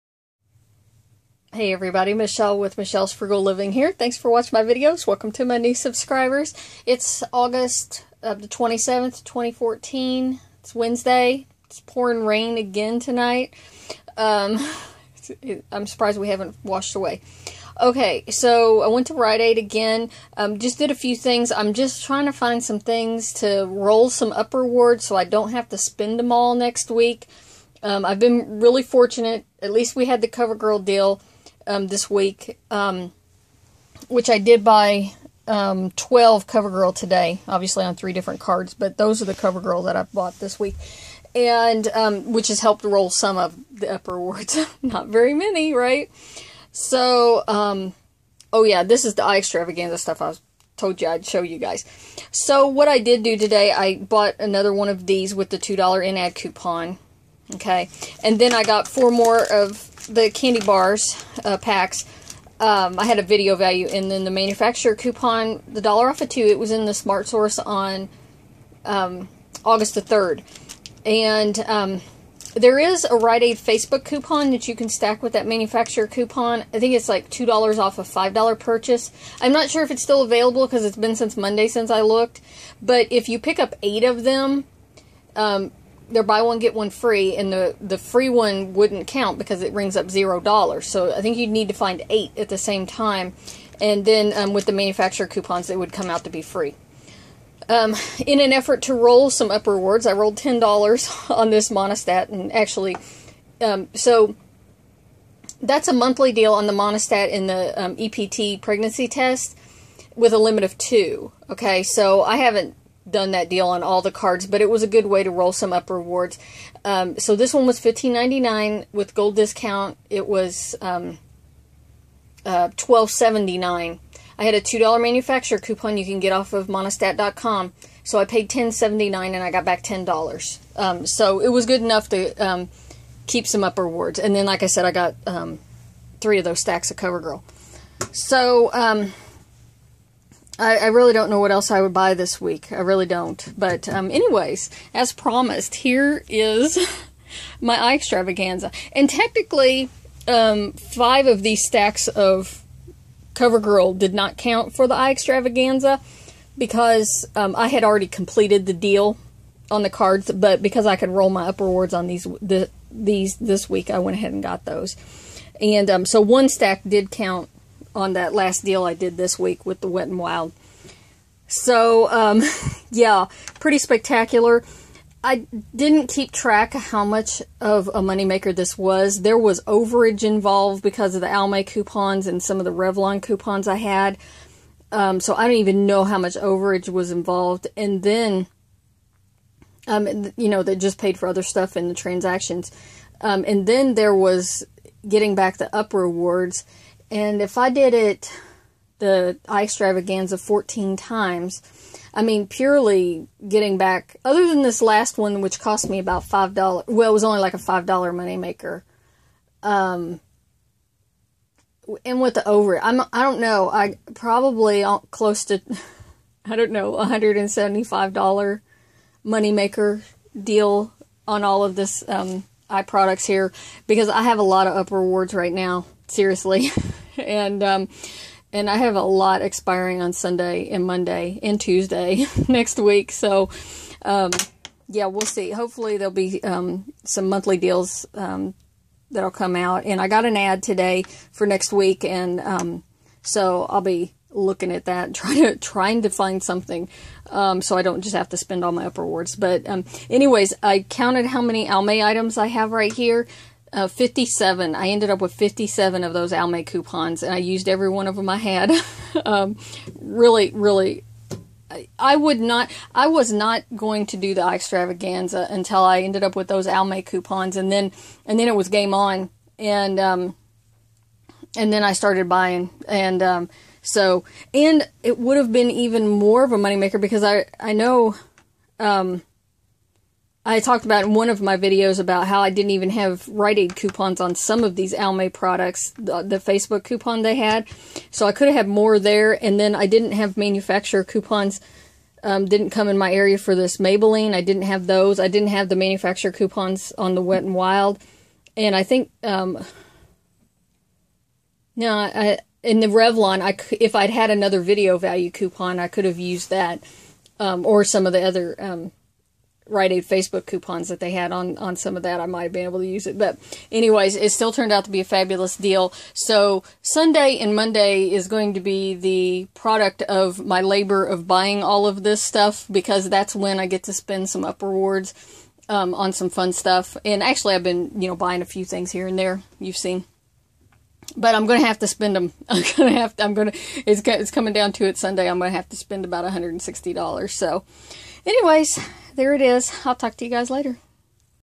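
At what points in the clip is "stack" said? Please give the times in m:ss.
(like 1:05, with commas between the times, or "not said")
1:14, 2:16, 2:31, 2:46.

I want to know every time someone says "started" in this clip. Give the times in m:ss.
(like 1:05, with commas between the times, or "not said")
4:31.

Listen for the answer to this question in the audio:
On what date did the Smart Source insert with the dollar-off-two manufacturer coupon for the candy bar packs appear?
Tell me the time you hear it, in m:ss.
1:09.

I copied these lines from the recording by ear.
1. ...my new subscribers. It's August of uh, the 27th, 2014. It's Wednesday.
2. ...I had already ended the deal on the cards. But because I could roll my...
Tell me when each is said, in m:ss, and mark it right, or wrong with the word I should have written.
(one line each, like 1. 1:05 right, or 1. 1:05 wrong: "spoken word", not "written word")
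1. 0:05 right
2. 2:37 wrong: "completed", not "ended".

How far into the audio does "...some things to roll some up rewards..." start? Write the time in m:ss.
0:22.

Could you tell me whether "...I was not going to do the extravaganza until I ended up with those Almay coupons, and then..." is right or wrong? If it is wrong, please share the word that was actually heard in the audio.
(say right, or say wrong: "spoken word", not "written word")
right.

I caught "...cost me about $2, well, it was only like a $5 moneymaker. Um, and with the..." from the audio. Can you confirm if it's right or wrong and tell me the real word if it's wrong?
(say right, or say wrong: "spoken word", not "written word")
wrong: "5", not "2".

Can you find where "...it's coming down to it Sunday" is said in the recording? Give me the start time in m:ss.
5:34.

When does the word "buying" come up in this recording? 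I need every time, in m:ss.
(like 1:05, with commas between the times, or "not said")
4:32, 5:21, 5:28.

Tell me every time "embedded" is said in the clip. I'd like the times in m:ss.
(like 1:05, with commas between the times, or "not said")
not said.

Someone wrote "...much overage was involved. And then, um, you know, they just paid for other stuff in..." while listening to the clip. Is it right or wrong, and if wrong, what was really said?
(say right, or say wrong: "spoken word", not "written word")
right.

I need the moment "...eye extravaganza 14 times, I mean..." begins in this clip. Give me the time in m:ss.
3:19.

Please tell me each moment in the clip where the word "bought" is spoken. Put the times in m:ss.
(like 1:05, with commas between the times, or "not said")
0:40, 0:53.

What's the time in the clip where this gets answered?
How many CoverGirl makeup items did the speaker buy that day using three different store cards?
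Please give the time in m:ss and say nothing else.
0:35.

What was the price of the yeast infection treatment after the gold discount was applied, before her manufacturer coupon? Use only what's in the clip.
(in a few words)
$12.79.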